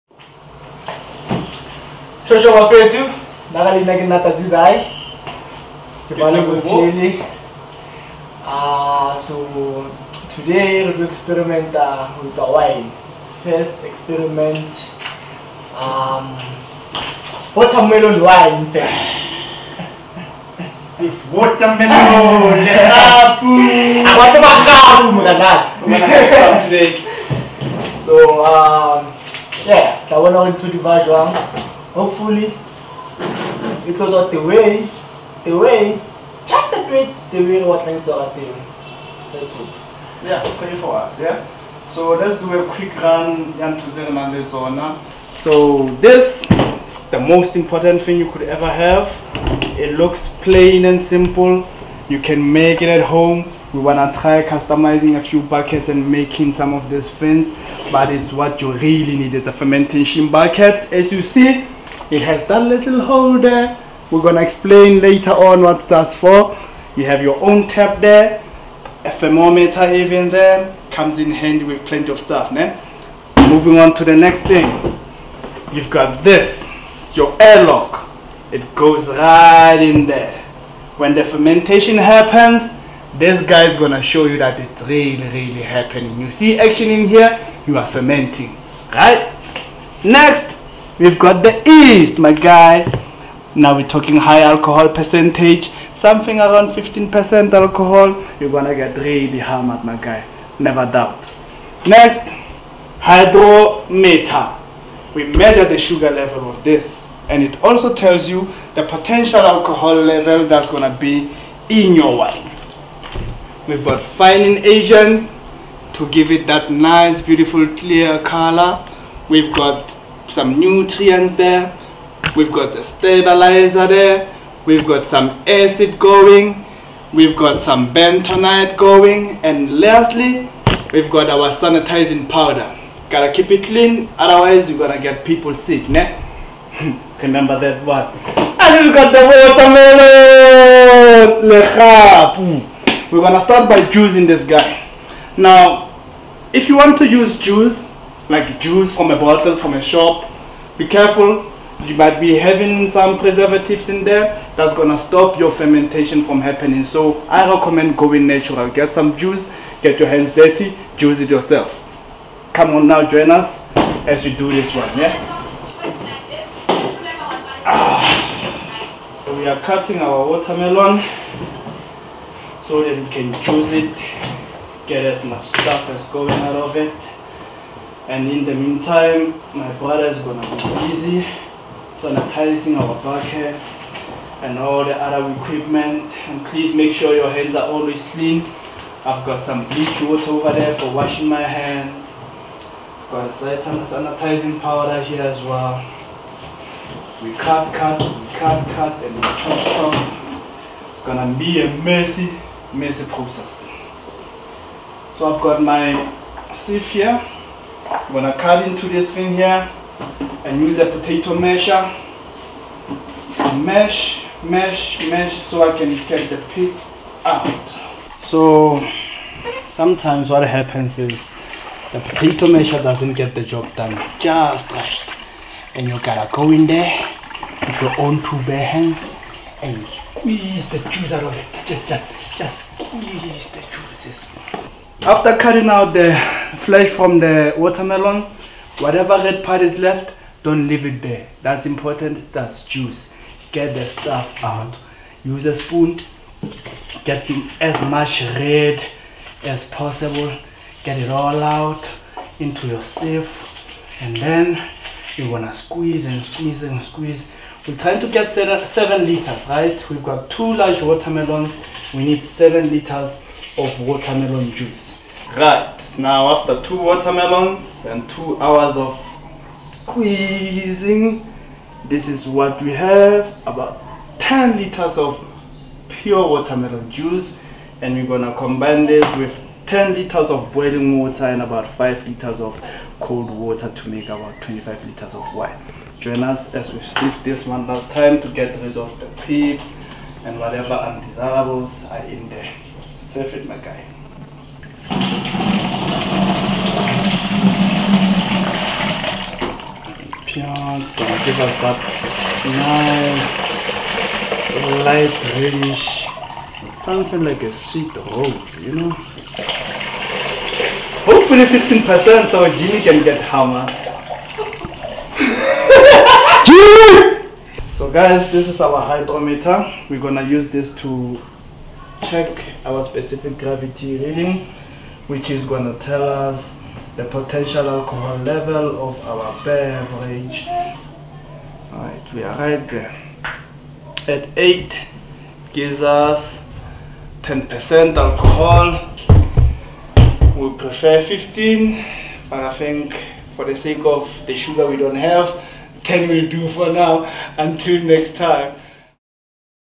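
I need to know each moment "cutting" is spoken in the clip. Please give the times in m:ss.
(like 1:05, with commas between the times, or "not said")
2:49, 3:55.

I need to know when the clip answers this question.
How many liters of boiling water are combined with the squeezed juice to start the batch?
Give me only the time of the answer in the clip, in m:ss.
4:39.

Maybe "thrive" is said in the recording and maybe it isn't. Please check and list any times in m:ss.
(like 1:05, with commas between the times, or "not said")
not said.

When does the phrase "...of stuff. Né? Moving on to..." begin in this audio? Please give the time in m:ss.
1:12.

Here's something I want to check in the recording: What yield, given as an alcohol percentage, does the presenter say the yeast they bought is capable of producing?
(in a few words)
15%.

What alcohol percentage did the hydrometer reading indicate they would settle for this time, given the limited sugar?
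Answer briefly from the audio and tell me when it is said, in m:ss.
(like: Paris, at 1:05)
10%, at 5:37.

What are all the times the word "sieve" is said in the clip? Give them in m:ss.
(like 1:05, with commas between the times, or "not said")
3:26, 4:12.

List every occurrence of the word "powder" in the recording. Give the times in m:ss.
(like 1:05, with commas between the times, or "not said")
2:12, 3:14.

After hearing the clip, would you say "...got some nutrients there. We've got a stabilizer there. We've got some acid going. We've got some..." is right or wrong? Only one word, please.
right.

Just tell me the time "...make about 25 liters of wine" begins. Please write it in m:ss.
4:43.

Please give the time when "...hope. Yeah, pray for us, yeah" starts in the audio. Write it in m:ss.
0:39.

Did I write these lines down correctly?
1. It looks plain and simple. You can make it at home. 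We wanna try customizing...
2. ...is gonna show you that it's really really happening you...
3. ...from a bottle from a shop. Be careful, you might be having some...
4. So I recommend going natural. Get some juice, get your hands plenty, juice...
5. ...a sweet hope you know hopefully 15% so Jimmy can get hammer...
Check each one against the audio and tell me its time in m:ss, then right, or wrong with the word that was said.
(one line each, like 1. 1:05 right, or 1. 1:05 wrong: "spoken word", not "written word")
1. 0:49 right
2. 1:23 right
3. 2:28 right
4. 2:36 wrong: "dirty", not "plenty"
5. 5:07 right.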